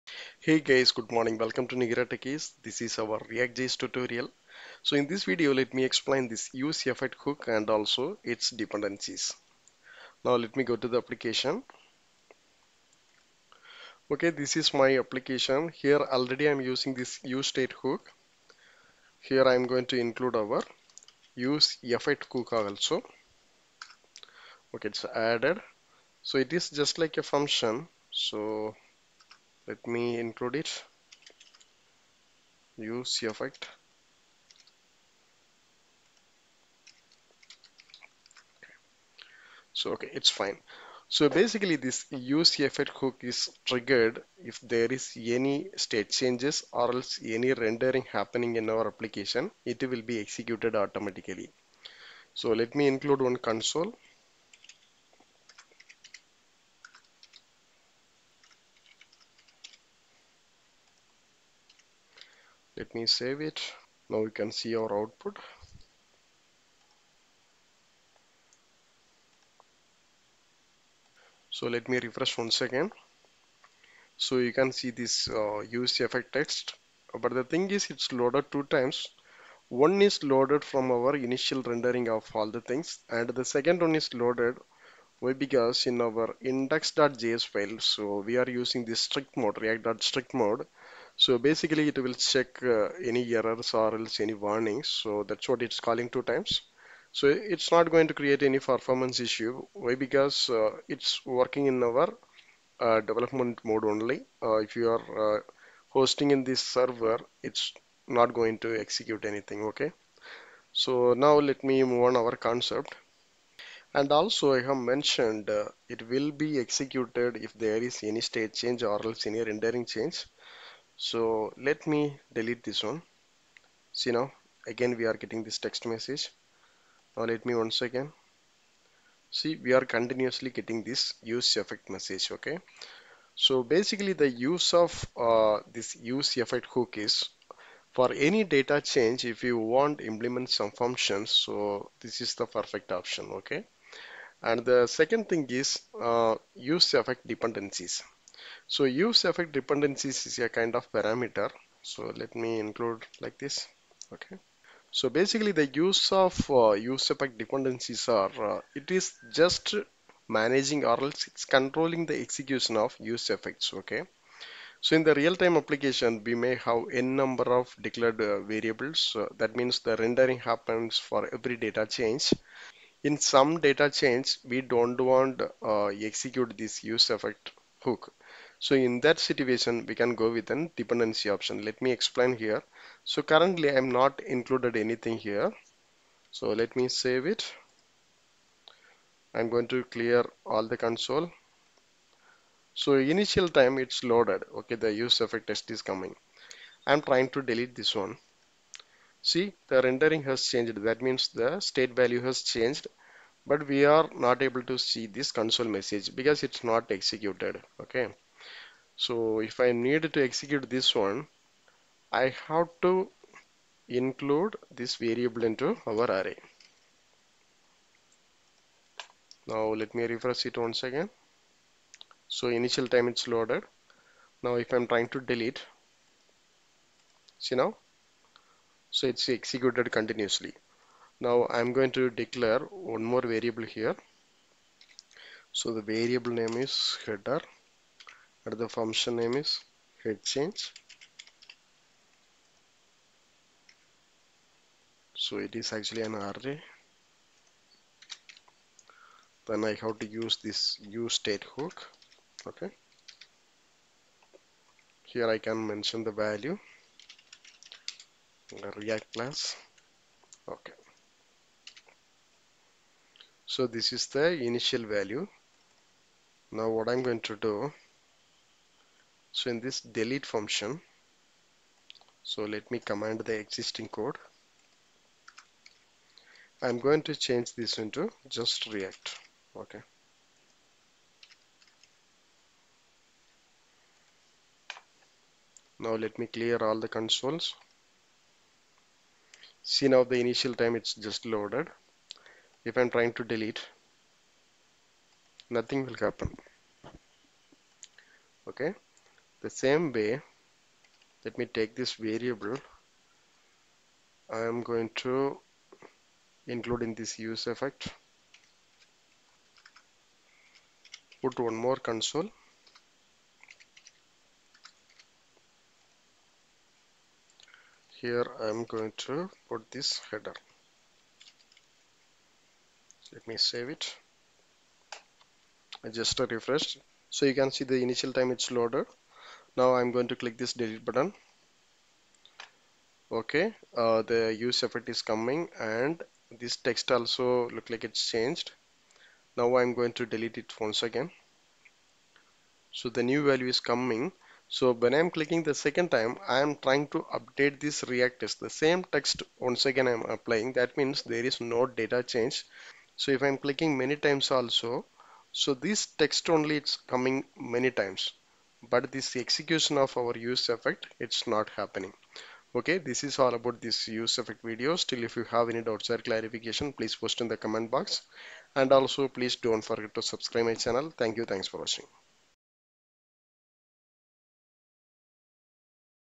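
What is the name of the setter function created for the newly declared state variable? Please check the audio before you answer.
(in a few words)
head change.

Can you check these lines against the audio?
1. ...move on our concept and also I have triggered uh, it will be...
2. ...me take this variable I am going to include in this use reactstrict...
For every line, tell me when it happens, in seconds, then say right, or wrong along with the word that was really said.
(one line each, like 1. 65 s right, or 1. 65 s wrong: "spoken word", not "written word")
1. 111 s wrong: "mentioned", not "triggered"
2. 301 s wrong: "effect", not "reactstrict".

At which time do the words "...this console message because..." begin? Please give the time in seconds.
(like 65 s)
205 s.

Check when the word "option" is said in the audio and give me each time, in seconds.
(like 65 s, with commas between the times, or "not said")
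142 s, 181 s.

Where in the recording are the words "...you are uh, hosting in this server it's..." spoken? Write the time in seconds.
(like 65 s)
104 s.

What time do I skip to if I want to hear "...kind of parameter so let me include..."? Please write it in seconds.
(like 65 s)
150 s.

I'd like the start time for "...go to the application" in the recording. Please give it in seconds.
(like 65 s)
10 s.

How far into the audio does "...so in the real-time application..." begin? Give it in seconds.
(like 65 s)
164 s.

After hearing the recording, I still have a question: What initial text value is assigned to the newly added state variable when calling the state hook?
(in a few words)
react class.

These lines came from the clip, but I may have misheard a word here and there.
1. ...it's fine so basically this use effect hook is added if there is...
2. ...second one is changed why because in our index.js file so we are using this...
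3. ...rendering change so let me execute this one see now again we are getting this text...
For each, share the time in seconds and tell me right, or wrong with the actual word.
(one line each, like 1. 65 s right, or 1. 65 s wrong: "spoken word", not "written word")
1. 40 s wrong: "triggered", not "added"
2. 83 s wrong: "loaded", not "changed"
3. 119 s wrong: "delete", not "execute".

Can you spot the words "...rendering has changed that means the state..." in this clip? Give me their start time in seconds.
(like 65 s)
199 s.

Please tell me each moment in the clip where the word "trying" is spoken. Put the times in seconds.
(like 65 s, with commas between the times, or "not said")
197 s, 224 s, 292 s, 346 s.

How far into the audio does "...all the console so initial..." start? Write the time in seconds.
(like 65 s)
190 s.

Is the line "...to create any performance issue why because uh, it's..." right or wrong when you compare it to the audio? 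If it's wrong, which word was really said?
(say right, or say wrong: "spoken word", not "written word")
right.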